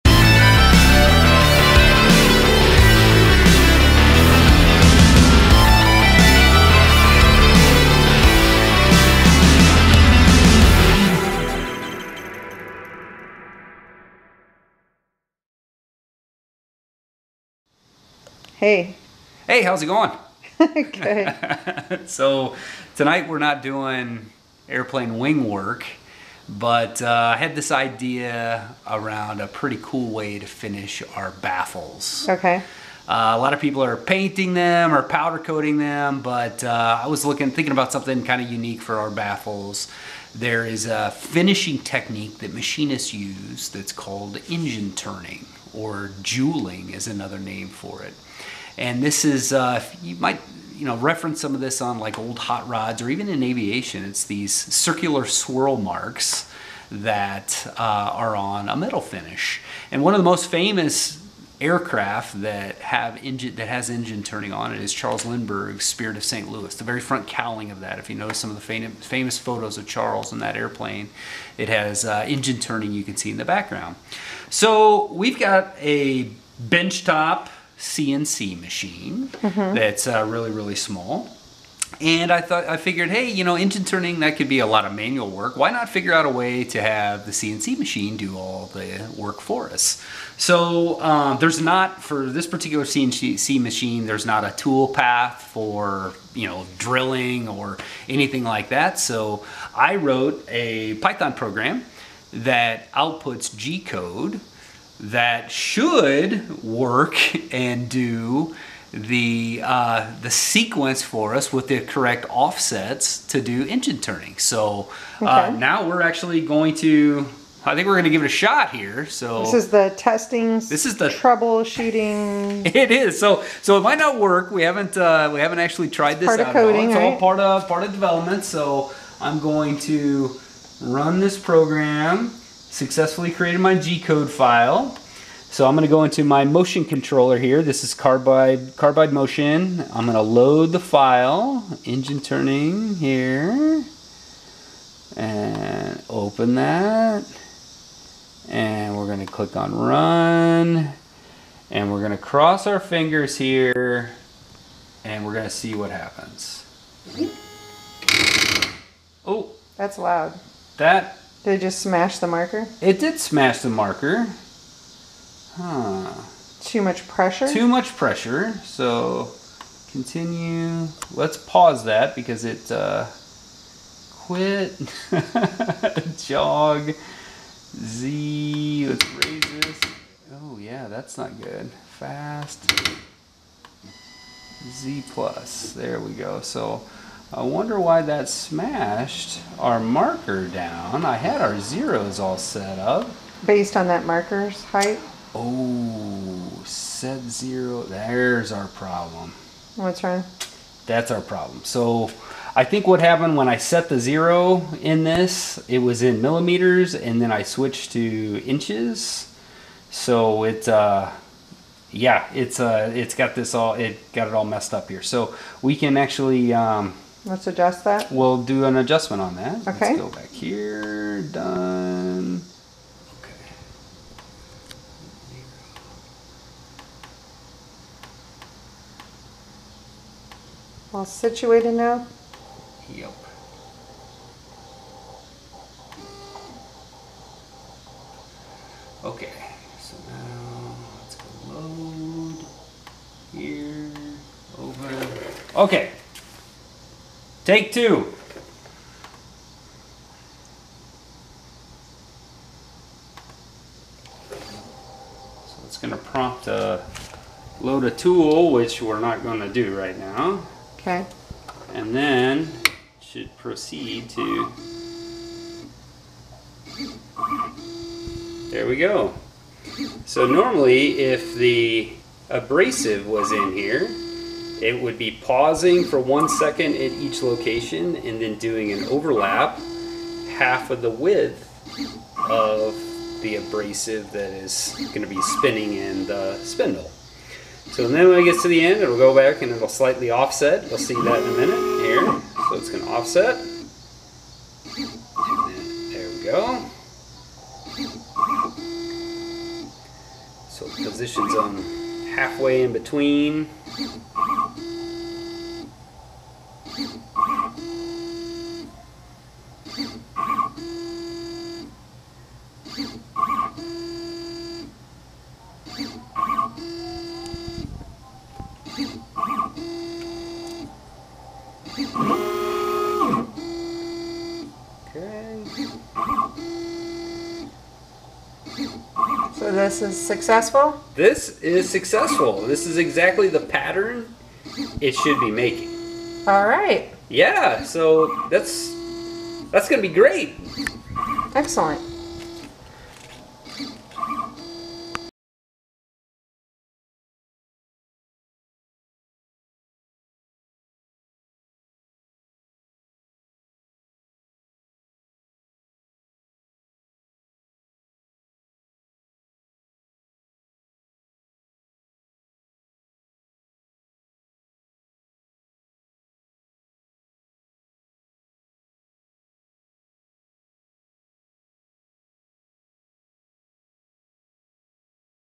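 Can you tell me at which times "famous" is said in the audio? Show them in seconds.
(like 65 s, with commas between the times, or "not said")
60 s, 68 s.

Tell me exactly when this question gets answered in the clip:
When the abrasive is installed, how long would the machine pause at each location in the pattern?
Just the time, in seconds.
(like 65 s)
275 s.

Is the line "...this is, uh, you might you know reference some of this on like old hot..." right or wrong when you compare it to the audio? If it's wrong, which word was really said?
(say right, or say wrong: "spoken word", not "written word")
right.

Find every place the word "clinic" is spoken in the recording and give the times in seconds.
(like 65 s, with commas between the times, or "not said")
not said.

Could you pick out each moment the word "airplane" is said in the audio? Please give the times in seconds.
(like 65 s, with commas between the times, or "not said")
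24 s, 70 s.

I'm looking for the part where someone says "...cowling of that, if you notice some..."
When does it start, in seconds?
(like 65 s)
67 s.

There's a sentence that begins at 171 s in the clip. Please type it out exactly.
Let's pause that because it uh, quit.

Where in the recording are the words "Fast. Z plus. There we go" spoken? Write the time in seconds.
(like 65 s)
181 s.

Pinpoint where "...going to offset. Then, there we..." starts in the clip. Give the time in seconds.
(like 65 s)
292 s.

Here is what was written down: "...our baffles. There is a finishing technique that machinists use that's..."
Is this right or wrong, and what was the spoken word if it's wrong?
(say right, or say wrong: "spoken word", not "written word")
right.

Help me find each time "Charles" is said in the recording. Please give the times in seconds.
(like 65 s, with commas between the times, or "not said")
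64 s, 69 s.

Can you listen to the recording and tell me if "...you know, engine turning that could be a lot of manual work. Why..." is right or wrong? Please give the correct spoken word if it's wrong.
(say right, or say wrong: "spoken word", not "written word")
right.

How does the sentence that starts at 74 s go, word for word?
So we've got a benchtop CNC machine mm-hmm.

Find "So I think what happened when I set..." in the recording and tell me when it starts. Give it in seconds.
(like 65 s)
201 s.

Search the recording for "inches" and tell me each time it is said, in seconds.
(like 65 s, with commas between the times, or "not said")
208 s.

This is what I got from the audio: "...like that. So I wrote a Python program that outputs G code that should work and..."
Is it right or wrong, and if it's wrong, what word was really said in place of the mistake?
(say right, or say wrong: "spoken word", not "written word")
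right.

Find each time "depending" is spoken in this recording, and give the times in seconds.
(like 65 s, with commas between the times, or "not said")
not said.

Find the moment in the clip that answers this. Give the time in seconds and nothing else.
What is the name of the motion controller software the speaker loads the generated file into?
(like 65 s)
138 s.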